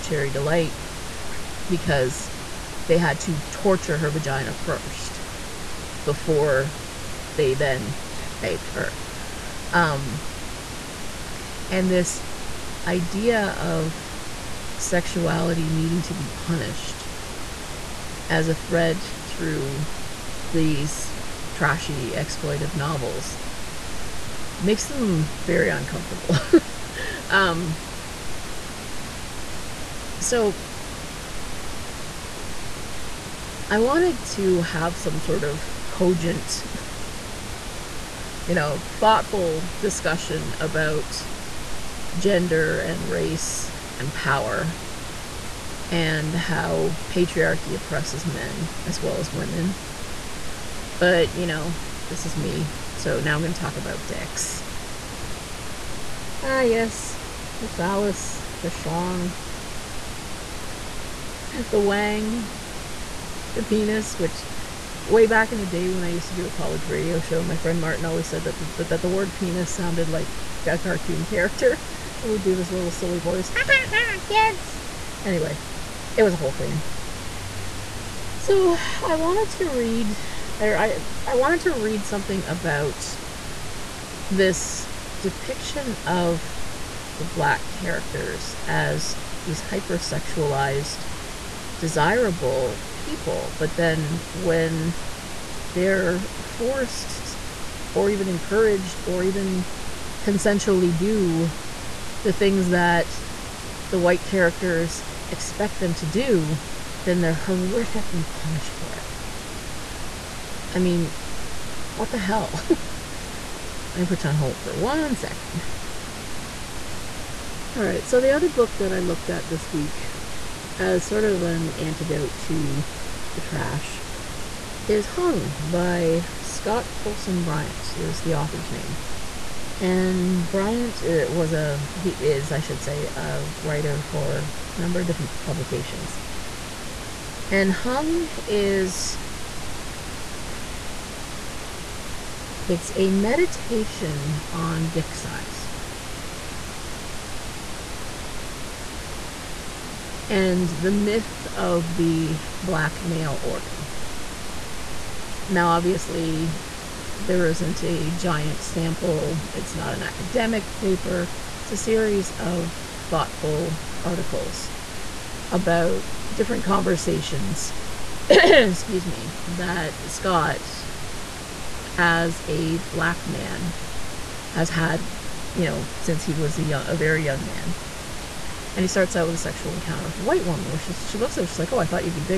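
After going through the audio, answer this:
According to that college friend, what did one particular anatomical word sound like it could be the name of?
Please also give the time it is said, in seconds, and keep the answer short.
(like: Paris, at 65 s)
a cartoon character, at 70 s.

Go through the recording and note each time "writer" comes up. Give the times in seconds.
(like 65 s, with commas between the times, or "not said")
133 s.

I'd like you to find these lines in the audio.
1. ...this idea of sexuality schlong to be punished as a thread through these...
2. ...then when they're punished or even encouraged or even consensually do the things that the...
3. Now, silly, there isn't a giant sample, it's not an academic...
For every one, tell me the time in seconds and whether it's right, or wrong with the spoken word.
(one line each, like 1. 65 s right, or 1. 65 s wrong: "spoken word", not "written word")
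1. 11 s wrong: "needing", not "schlong"
2. 93 s wrong: "forced", not "punished"
3. 155 s wrong: "obviously", not "silly".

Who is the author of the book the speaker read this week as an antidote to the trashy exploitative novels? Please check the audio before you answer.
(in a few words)
Scott Poulson-Bryant.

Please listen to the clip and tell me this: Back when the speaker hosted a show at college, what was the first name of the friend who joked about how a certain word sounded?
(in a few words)
Martin.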